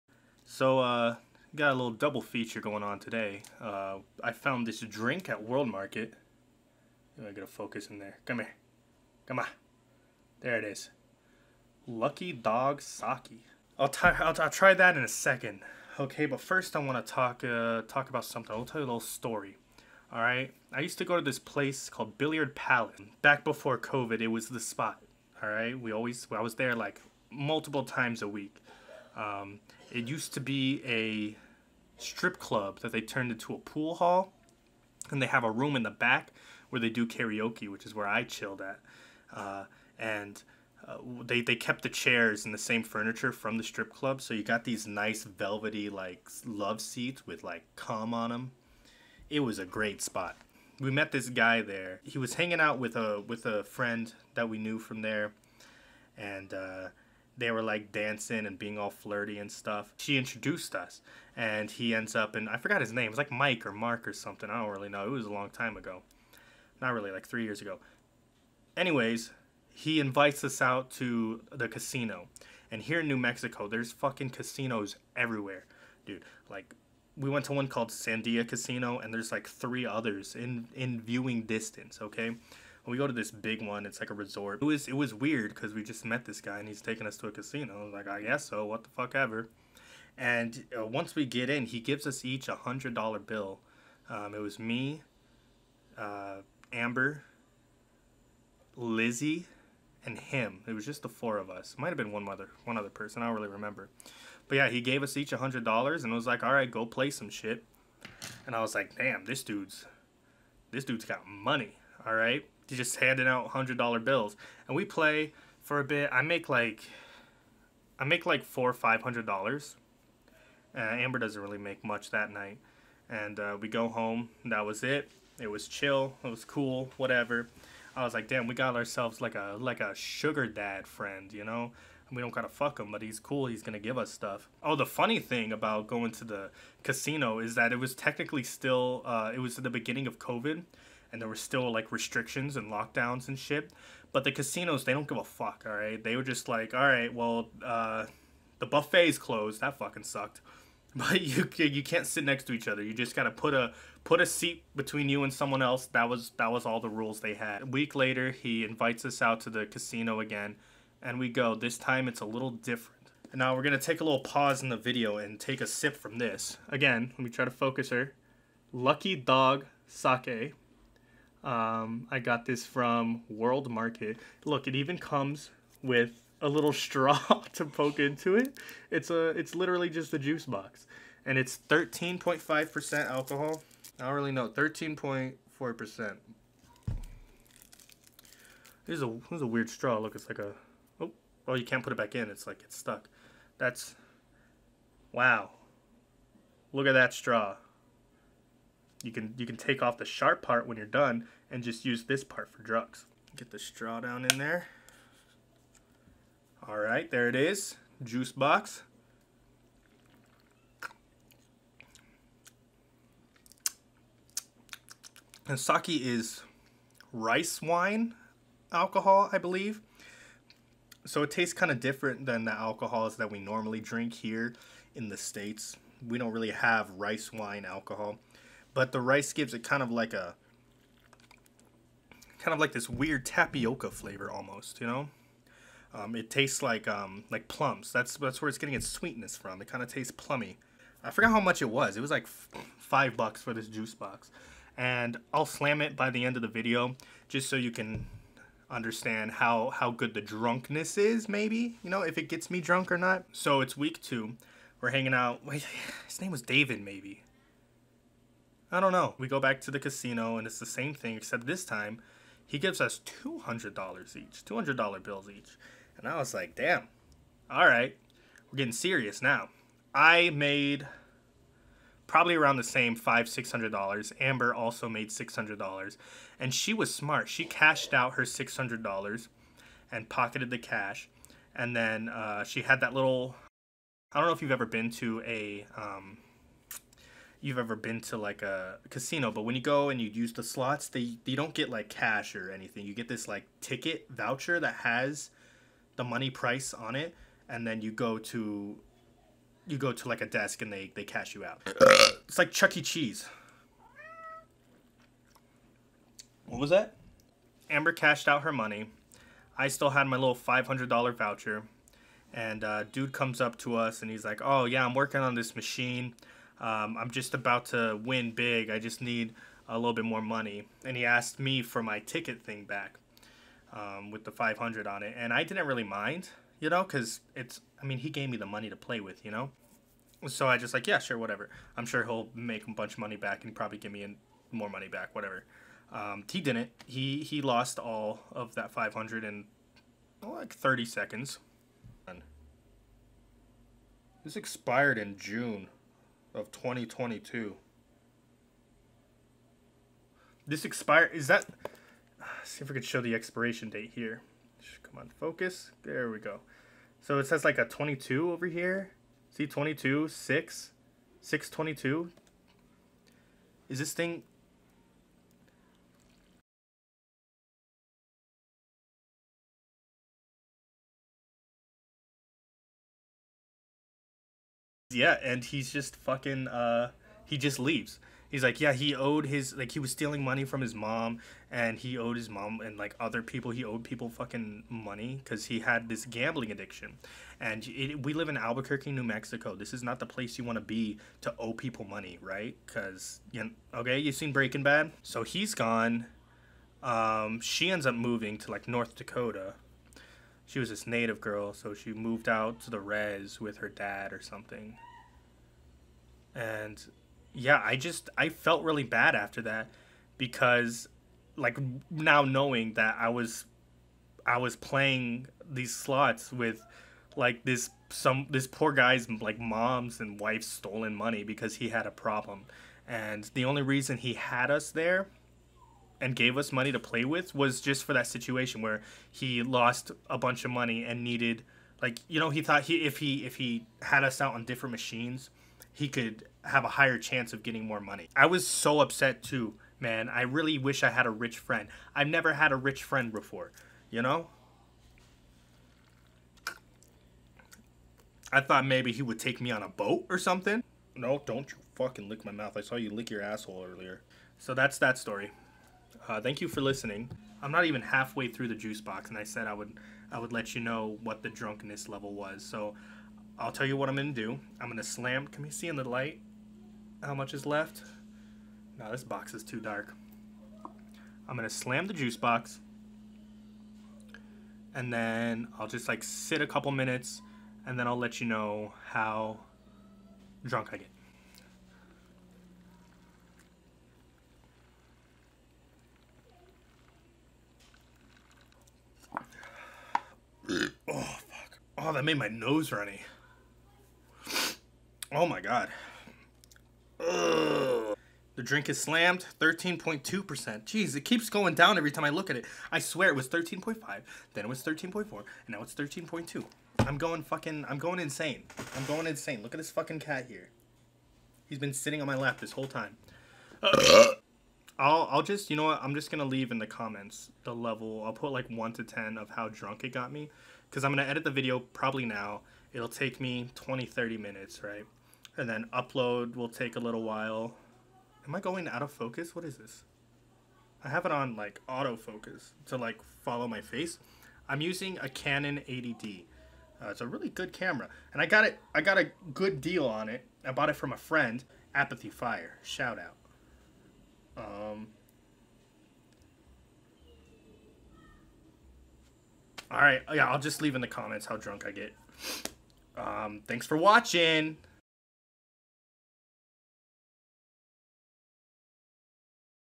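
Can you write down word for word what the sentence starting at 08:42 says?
It'll take me 20, 30 minutes, right?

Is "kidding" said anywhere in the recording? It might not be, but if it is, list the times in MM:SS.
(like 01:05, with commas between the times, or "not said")
not said.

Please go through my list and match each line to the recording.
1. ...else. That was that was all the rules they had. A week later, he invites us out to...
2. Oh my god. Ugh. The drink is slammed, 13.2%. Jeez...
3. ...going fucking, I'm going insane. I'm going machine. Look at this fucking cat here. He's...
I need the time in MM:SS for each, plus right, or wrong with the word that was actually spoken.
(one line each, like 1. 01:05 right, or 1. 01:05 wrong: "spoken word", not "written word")
1. 02:35 right
2. 08:15 right
3. 08:26 wrong: "insane", not "machine".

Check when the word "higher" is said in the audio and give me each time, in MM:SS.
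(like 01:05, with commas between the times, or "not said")
07:16.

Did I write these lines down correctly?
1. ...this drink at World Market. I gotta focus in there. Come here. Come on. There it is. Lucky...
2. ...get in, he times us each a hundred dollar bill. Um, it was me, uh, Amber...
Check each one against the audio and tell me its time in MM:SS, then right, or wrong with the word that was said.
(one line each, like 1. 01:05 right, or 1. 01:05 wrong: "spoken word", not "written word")
1. 00:04 right
2. 01:31 wrong: "gives", not "times".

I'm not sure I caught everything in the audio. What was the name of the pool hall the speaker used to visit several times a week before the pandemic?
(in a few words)
Billiard Palace.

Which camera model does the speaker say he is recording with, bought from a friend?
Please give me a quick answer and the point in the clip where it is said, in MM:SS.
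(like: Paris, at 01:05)
Canon 80D, at 08:55.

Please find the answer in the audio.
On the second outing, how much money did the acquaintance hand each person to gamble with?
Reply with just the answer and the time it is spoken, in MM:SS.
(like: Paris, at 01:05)
$200, at 04:23.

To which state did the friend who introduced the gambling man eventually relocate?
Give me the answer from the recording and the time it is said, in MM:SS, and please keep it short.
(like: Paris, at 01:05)
North Dakota, at 06:38.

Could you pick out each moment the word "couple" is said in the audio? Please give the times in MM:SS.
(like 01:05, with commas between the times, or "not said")
07:56.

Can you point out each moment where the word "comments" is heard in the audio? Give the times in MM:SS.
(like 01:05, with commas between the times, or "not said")
08:36, 09:10.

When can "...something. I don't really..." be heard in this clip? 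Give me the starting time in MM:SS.
01:04.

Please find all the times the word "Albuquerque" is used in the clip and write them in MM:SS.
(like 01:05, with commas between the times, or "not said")
06:28.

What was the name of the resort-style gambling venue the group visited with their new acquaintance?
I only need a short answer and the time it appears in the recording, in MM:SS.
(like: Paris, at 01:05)
Sandia Casino, at 01:17.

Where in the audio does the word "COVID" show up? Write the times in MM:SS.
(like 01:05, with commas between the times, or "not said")
00:23, 02:20.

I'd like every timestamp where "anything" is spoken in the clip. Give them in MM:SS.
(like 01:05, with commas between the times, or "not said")
04:52.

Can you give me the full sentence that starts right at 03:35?
And sake is rice wine alcohol, I believe.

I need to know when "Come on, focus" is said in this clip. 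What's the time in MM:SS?
05:54.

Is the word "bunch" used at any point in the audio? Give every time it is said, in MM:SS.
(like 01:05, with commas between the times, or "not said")
05:32, 07:10.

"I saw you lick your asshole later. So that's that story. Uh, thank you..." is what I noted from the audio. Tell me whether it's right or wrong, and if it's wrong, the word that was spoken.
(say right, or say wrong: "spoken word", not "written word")
wrong: "earlier", not "later".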